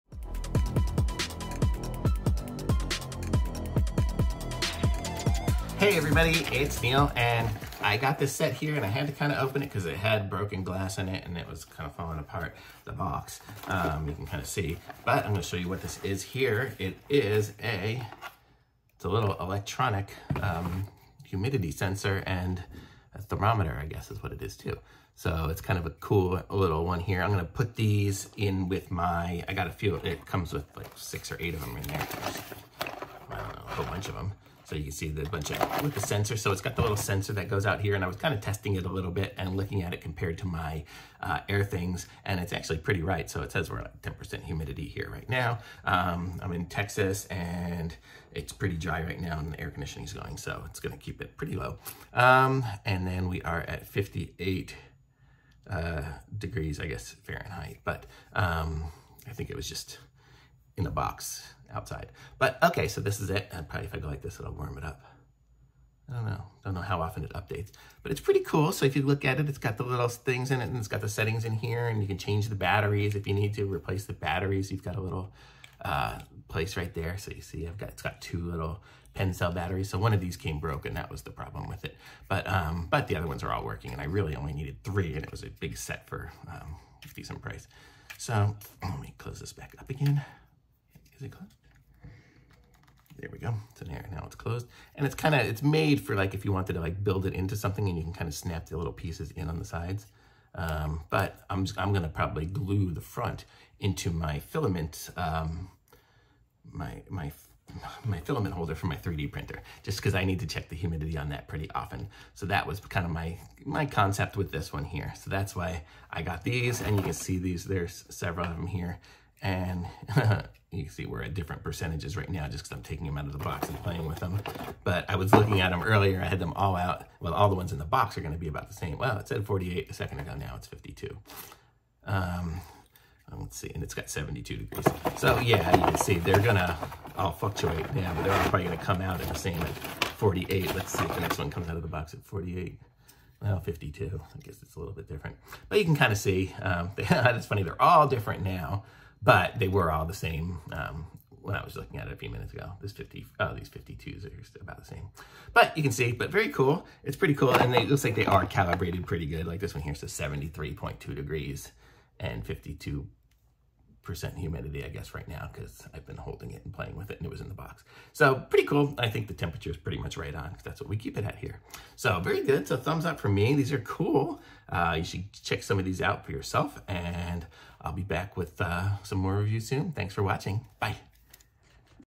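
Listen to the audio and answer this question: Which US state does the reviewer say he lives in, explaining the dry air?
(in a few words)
Texas.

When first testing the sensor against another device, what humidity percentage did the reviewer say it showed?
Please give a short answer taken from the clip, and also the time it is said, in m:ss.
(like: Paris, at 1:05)
10%, at 0:44.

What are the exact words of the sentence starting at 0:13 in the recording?
Um, you can kind of see, but I'm going to show you what this is here.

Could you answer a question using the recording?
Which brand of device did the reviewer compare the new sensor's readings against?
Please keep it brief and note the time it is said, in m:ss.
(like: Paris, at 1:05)
Airthings, at 0:41.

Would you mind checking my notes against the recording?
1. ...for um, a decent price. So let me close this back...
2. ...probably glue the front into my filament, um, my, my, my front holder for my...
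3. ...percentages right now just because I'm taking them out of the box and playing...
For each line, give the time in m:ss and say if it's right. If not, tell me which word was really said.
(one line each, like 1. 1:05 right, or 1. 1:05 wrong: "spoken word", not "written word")
1. 1:26 right
2. 1:42 wrong: "filament", not "front"
3. 2:01 right.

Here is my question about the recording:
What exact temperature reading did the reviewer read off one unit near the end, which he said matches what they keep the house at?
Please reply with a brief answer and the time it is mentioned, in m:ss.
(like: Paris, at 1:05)
73.2 degrees, at 2:40.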